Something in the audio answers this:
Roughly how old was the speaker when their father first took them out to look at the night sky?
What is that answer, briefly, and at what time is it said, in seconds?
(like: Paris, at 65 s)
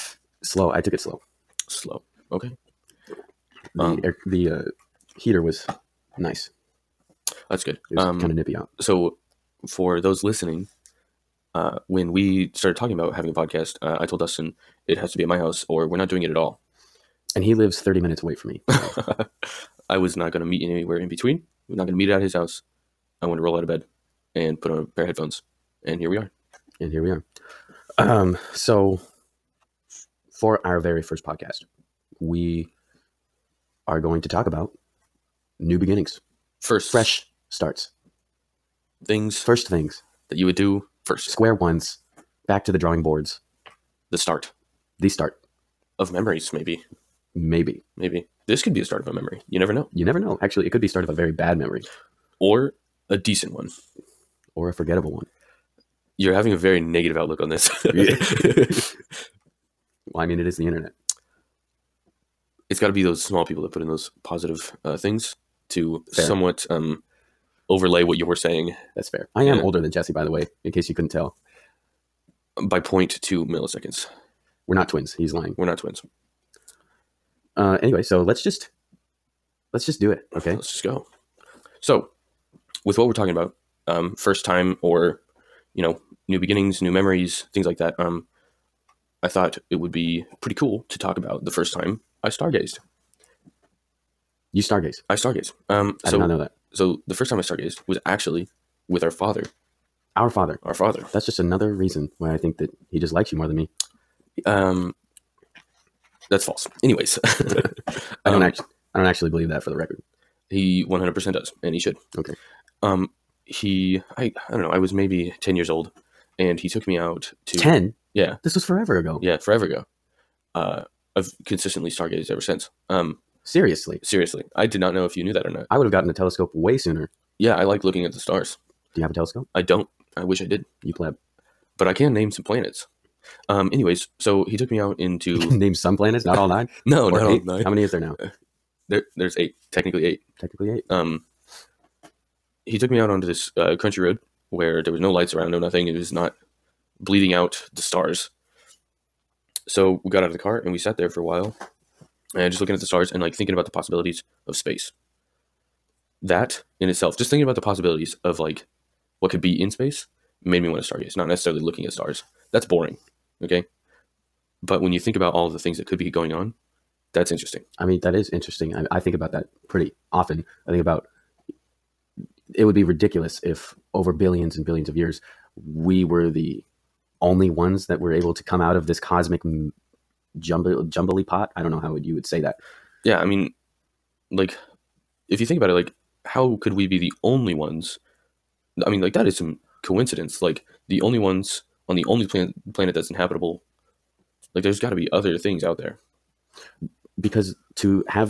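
10, at 115 s.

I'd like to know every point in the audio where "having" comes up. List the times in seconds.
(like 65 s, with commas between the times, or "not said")
13 s, 56 s.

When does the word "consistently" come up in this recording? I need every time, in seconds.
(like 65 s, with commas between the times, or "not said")
121 s.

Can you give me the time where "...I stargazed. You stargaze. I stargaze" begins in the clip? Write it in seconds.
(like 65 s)
92 s.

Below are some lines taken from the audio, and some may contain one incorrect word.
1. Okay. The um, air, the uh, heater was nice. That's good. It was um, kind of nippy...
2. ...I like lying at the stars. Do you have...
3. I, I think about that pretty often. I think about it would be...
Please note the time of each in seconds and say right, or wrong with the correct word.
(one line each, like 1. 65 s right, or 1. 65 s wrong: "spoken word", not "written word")
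1. 2 s right
2. 127 s wrong: "looking", not "lying"
3. 168 s right.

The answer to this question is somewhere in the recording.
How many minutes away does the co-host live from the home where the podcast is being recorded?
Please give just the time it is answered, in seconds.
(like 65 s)
17 s.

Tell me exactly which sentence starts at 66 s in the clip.
somewhat um, overlay what you're saying.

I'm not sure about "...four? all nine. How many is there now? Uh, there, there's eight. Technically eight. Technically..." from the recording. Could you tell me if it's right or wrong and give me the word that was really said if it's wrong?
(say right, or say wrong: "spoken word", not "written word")
wrong: "eight", not "four".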